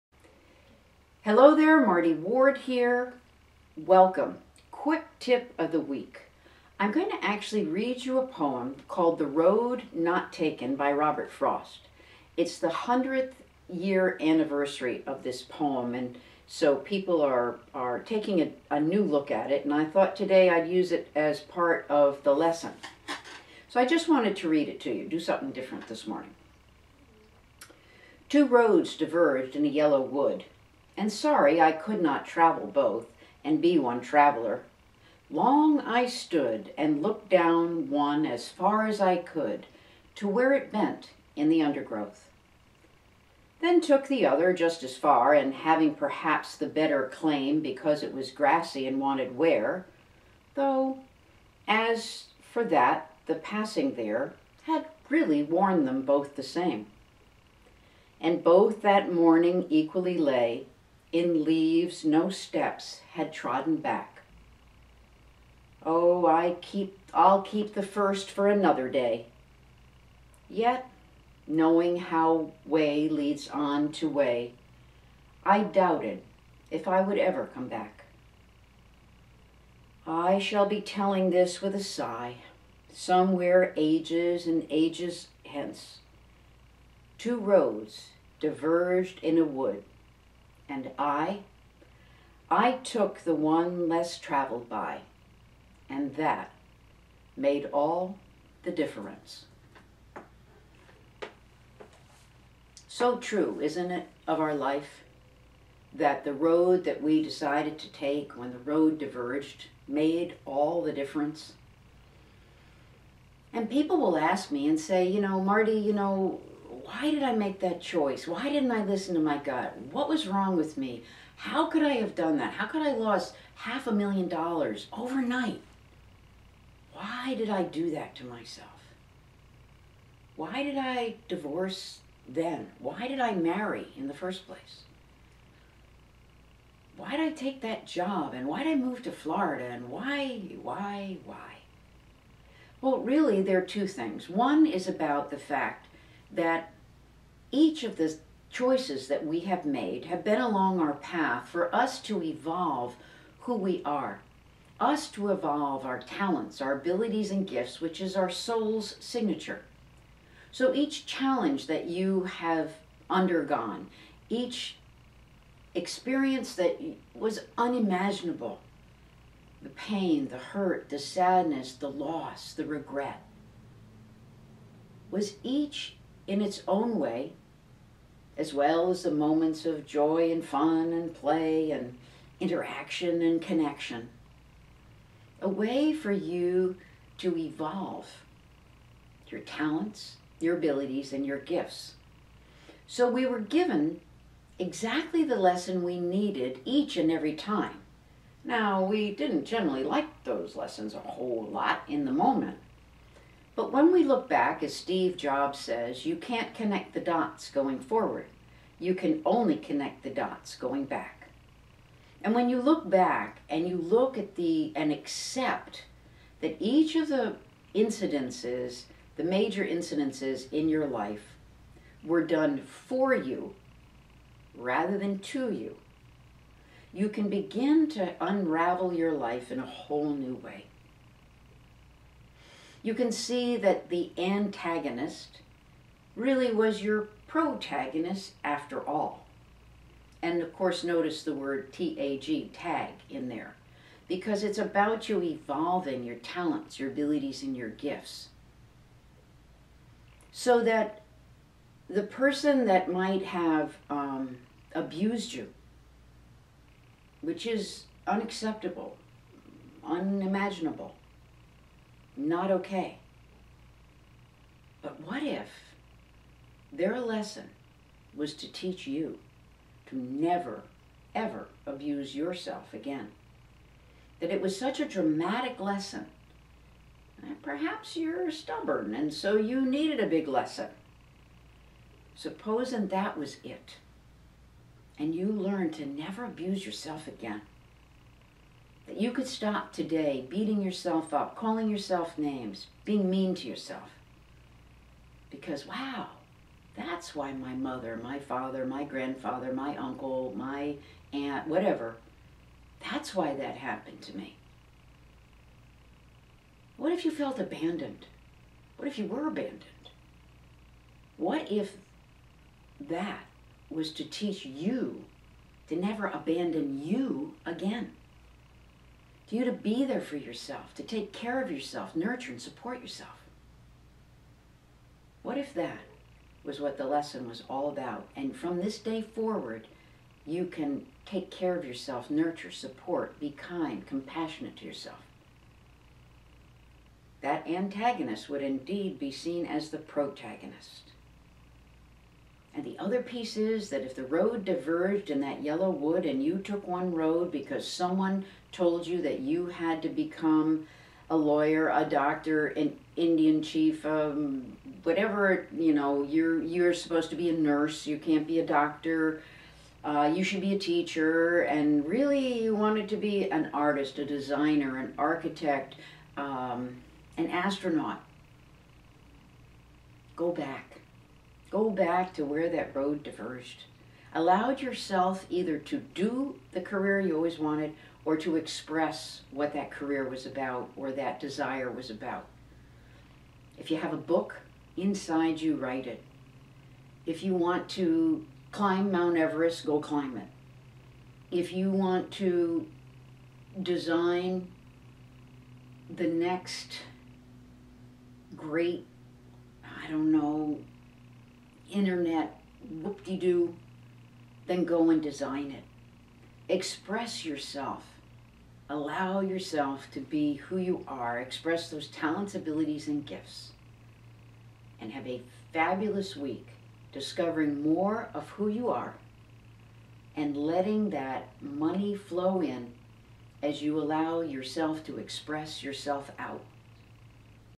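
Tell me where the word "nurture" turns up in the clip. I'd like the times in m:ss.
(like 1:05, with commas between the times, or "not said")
5:21, 5:32.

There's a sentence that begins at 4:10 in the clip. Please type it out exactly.
So that the person that might have um, abused you, which is unacceptable, unimaginable, not okay.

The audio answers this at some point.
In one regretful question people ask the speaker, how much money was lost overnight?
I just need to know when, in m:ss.
2:03.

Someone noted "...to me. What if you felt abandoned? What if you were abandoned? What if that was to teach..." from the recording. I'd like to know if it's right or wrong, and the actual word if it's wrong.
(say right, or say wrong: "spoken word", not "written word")
right.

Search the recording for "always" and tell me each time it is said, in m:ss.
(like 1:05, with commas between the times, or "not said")
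6:17.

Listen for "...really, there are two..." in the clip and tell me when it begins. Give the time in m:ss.
2:22.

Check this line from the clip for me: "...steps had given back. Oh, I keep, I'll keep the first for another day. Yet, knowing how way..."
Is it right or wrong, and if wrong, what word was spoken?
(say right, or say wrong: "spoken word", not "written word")
wrong: "trodden", not "given".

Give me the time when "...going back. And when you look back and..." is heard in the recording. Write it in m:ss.
3:30.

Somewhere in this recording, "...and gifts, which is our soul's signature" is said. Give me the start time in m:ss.
2:37.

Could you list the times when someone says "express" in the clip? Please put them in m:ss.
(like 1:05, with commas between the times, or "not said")
6:18, 6:46, 6:51, 7:04.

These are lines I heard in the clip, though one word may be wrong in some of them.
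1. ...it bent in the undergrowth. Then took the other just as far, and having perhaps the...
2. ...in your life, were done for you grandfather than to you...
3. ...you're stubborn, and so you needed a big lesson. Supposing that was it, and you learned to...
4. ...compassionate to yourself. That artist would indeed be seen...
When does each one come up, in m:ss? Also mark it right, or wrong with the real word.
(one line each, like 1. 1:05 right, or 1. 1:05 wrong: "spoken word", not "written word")
1. 0:40 right
2. 3:40 wrong: "rather", not "grandfather"
3. 4:37 right
4. 5:33 wrong: "antagonist", not "artist".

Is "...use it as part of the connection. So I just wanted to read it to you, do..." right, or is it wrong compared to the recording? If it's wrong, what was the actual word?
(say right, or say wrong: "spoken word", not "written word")
wrong: "lesson", not "connection".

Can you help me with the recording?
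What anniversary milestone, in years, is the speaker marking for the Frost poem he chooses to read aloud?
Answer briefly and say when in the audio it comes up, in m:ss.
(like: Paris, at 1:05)
100th, at 0:12.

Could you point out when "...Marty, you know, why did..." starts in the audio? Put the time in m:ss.
1:55.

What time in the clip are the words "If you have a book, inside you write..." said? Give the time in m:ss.
6:23.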